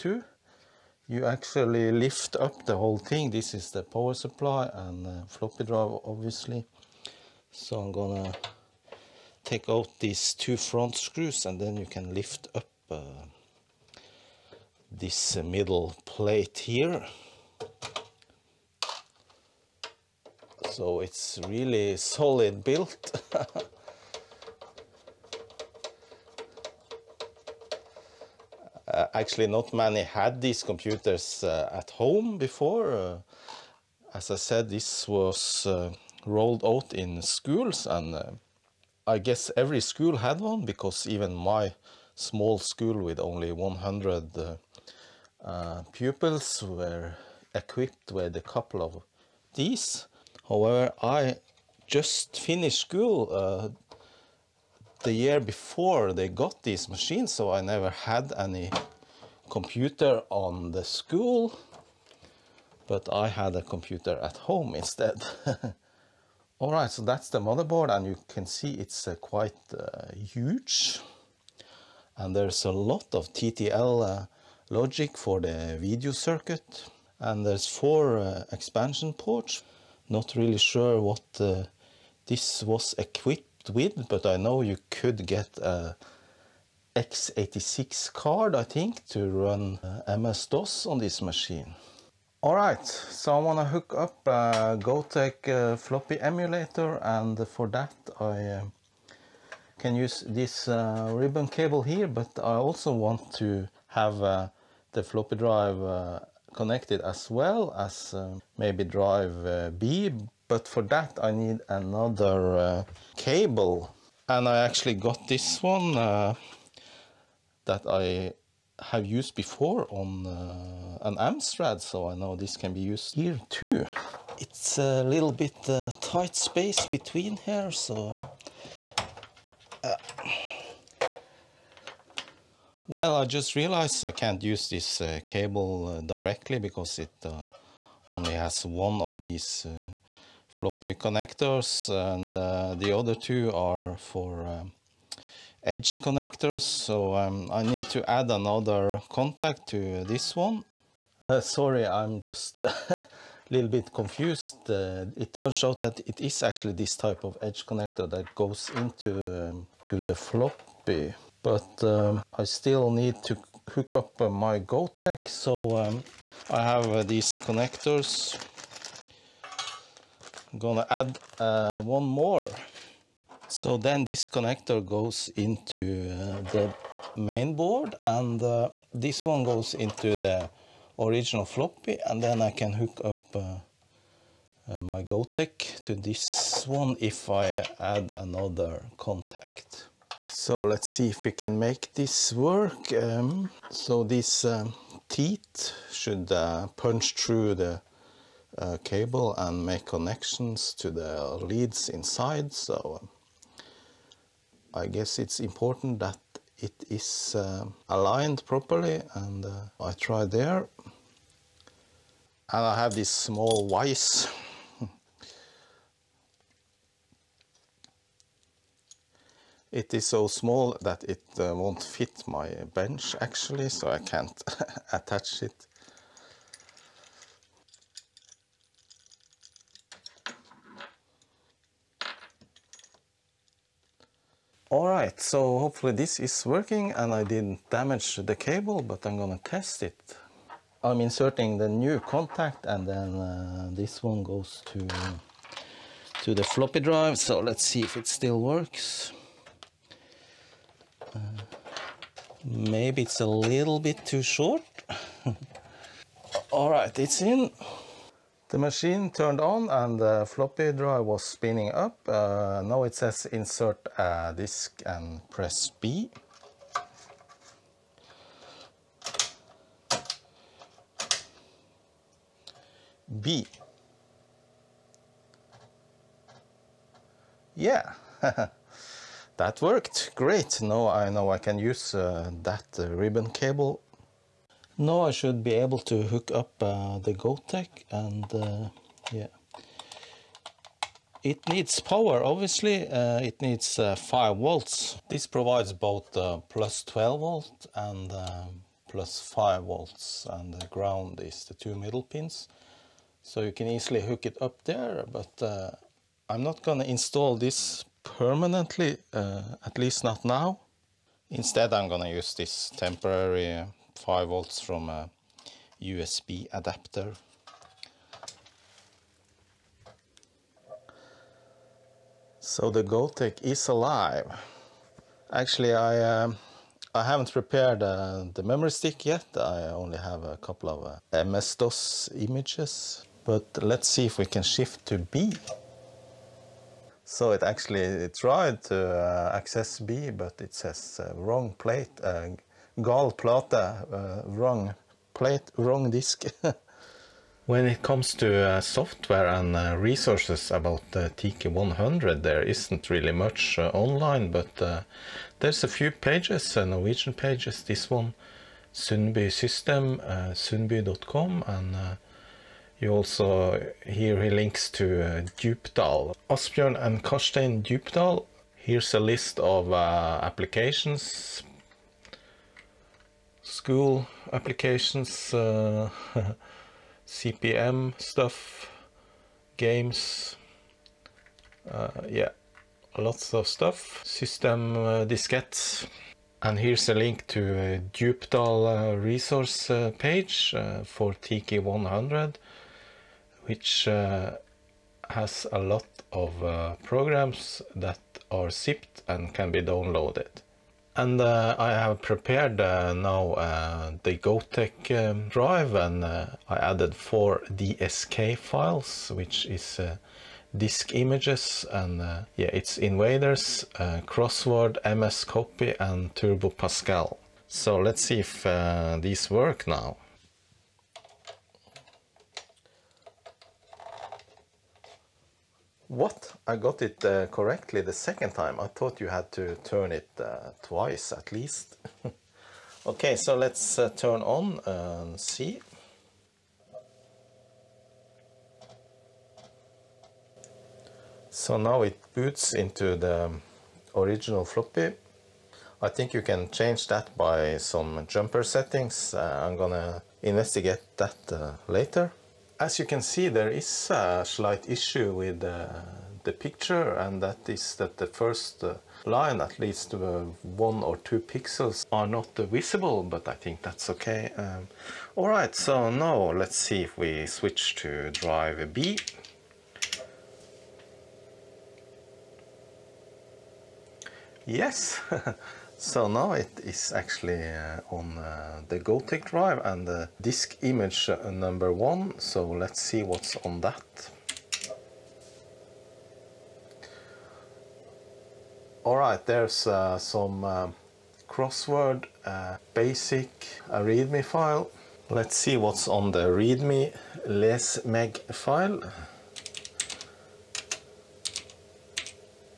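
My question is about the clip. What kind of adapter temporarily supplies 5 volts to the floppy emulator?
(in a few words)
USB adapter.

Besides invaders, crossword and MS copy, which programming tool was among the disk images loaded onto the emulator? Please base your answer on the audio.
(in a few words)
Turbo Pascal.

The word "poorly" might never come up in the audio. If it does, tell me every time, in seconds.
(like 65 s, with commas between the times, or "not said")
not said.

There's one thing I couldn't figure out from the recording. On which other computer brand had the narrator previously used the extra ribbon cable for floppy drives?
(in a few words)
Amstrad.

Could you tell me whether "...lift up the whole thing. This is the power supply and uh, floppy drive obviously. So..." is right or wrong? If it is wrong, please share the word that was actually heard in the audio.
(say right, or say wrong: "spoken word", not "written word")
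right.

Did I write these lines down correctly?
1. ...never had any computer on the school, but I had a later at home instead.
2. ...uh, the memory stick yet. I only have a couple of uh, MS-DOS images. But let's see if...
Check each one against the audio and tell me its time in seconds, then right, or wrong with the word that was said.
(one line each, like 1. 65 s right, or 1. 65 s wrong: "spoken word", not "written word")
1. 57 s wrong: "computer", not "later"
2. 327 s right.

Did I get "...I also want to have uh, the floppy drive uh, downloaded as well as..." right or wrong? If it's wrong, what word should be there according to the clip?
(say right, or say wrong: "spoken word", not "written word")
wrong: "connected", not "downloaded".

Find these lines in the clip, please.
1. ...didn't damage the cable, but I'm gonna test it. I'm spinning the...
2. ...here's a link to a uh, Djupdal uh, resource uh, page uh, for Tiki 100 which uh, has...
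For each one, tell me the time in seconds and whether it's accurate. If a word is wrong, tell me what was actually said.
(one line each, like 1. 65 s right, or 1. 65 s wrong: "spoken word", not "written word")
1. 237 s wrong: "inserting", not "spinning"
2. 386 s right.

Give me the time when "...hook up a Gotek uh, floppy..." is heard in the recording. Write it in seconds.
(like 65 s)
93 s.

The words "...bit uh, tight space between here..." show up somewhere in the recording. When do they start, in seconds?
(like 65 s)
125 s.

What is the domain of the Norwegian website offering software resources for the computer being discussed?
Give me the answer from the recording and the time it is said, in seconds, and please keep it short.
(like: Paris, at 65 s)
sundby.com, at 360 s.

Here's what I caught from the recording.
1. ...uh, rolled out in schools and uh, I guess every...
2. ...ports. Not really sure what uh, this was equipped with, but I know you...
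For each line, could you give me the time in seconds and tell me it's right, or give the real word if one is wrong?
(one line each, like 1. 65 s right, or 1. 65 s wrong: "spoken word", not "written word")
1. 35 s right
2. 79 s right.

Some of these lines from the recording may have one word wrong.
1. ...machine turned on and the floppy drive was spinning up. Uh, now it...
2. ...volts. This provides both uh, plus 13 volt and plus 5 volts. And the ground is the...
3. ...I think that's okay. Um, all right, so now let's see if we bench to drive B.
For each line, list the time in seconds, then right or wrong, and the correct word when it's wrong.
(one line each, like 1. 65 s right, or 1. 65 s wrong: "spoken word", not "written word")
1. 258 s right
2. 294 s wrong: "12", not "13"
3. 463 s wrong: "switch", not "bench".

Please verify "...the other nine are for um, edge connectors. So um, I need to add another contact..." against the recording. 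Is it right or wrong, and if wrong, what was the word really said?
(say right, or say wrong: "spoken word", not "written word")
wrong: "two", not "nine".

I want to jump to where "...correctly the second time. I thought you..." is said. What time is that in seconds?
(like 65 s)
427 s.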